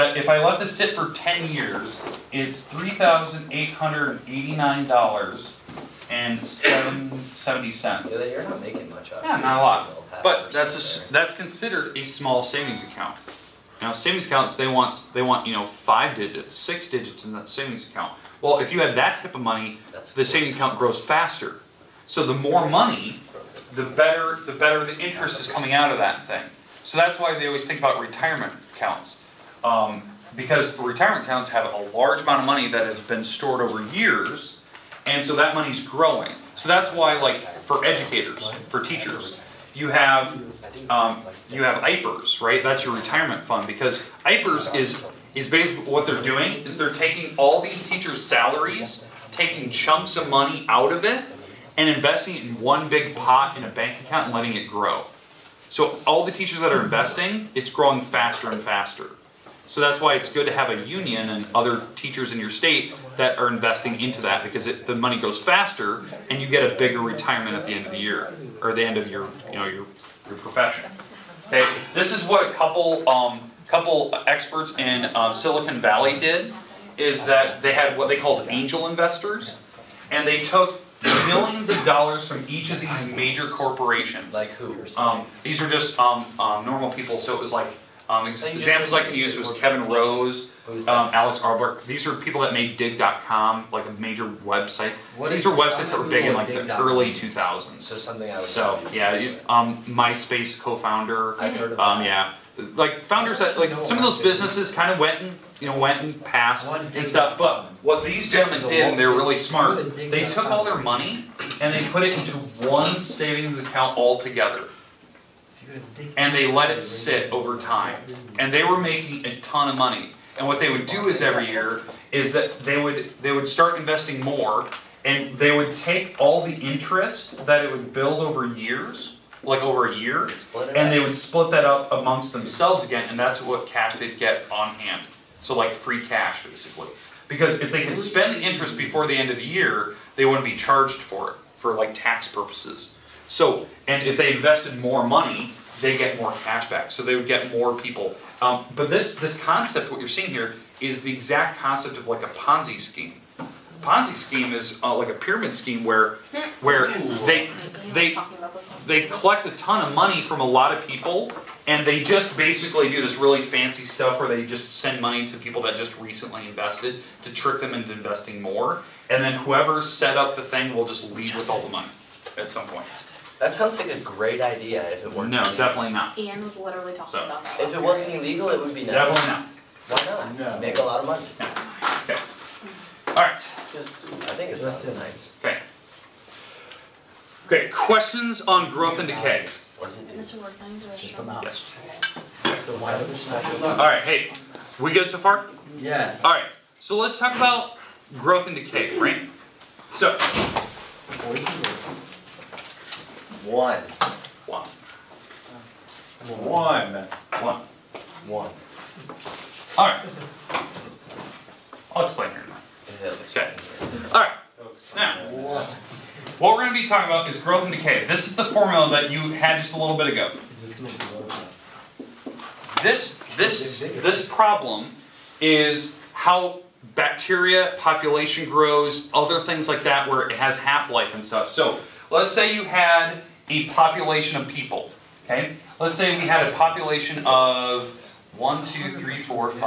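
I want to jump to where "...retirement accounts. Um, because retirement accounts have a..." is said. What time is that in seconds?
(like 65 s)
28 s.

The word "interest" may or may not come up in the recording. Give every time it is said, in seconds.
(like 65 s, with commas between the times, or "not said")
24 s, 126 s, 138 s.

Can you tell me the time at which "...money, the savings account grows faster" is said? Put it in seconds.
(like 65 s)
19 s.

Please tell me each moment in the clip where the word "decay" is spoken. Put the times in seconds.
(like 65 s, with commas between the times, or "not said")
189 s, 198 s, 217 s.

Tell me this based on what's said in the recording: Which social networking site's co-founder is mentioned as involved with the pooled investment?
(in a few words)
MySpace.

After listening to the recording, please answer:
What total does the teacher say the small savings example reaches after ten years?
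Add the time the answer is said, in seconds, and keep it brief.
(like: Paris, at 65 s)
$3,889.70, at 2 s.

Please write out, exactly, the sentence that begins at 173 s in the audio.
That sounds like a great idea if it were No, illegal.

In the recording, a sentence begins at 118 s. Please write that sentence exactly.
And they were making a ton of money.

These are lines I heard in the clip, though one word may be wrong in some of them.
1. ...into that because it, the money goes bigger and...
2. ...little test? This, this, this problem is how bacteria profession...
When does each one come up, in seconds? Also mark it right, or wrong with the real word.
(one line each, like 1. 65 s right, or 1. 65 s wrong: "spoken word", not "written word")
1. 63 s wrong: "faster", not "bigger"
2. 221 s wrong: "population", not "profession".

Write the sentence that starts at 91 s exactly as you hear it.
These are people that made Digg.com, like a major website.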